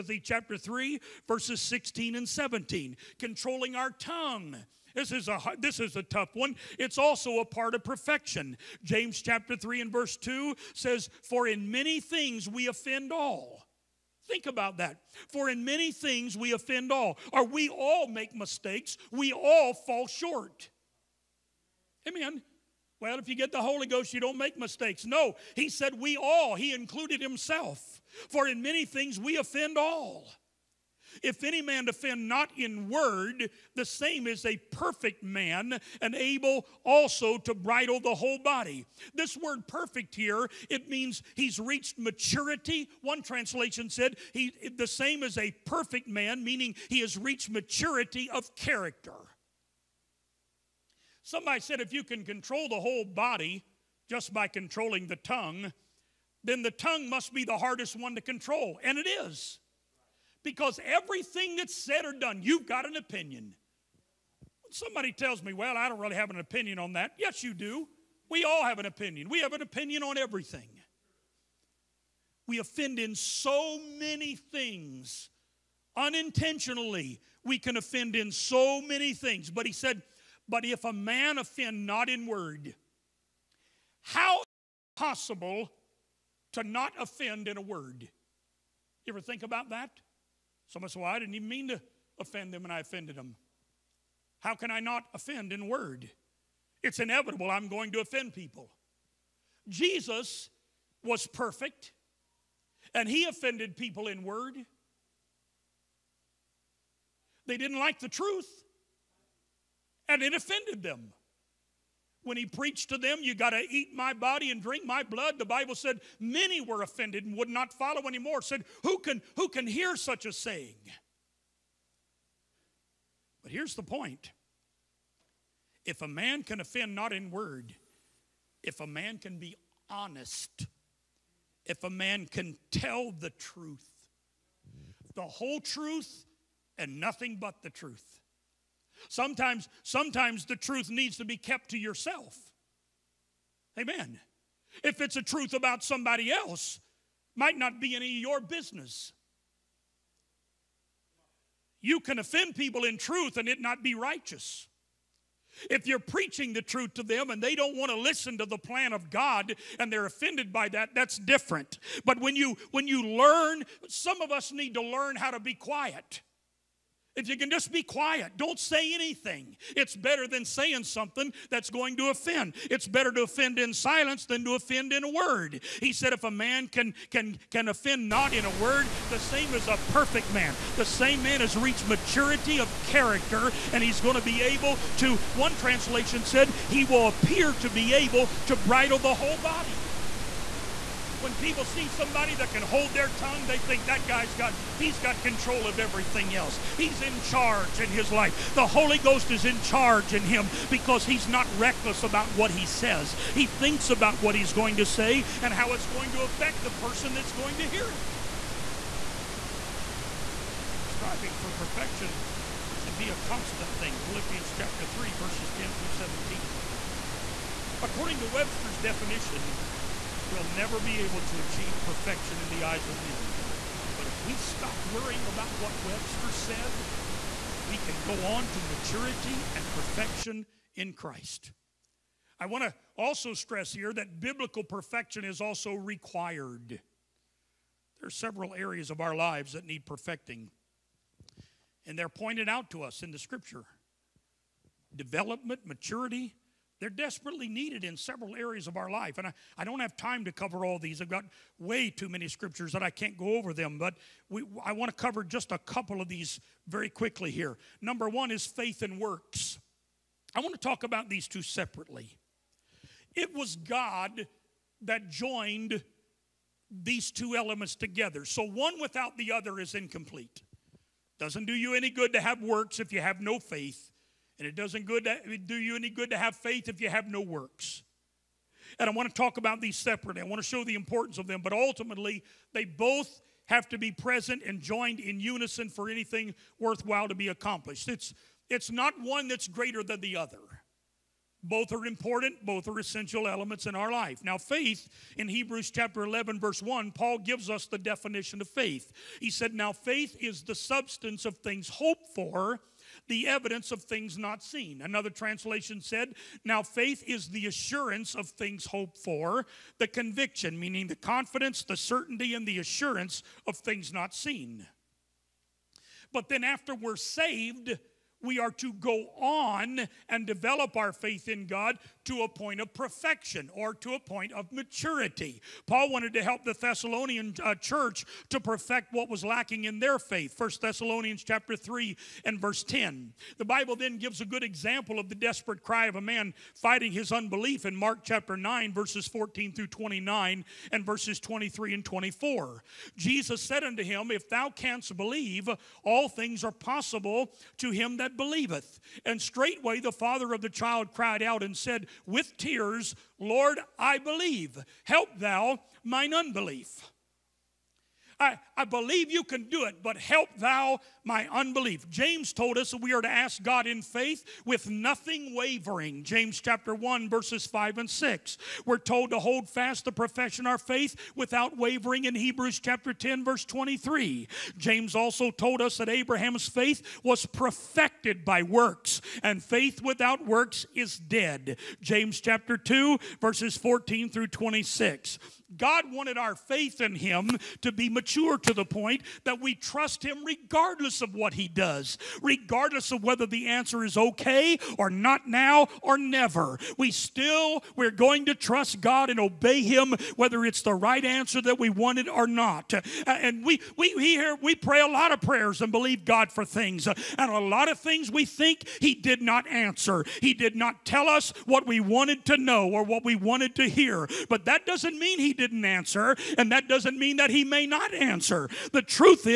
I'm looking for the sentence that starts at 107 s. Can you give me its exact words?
They didn't like the truth and it offended them.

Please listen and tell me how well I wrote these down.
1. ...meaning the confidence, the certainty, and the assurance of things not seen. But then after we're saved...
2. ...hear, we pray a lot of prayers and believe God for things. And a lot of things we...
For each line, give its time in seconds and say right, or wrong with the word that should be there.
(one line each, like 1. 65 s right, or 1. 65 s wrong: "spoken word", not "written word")
1. 310 s right
2. 404 s right.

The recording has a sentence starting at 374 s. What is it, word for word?
James also told us that Abraham's faith was perfected by works, and faith without works is dead.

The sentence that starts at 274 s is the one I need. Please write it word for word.
And it doesn't good to, do you any good to have faith if you have no works.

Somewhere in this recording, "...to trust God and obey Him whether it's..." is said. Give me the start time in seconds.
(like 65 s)
398 s.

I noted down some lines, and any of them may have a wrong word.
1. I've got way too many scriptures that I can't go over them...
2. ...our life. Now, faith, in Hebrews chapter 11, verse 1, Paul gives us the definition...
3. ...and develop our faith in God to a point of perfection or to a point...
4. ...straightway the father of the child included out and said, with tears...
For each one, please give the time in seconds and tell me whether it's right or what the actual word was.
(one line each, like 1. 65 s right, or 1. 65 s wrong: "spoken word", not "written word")
1. 250 s right
2. 293 s right
3. 320 s right
4. 349 s wrong: "cried", not "included".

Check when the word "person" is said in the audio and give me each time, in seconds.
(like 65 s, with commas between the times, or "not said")
206 s.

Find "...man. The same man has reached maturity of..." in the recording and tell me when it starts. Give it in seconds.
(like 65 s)
180 s.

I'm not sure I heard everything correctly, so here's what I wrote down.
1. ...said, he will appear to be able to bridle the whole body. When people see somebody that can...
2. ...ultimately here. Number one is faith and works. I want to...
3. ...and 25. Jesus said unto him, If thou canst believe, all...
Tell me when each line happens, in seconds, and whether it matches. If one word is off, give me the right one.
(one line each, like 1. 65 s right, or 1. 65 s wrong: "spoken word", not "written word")
1. 186 s right
2. 256 s wrong: "quickly", not "ultimately"
3. 341 s wrong: "24", not "25".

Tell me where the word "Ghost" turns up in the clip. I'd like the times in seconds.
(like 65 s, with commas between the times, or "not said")
23 s, 198 s.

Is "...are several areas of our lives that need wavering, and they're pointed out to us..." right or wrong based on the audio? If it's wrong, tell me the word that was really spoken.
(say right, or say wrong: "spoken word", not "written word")
wrong: "perfecting", not "wavering".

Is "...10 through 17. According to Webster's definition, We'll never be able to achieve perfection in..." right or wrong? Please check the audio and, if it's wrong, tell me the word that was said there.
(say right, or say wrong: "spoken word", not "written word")
right.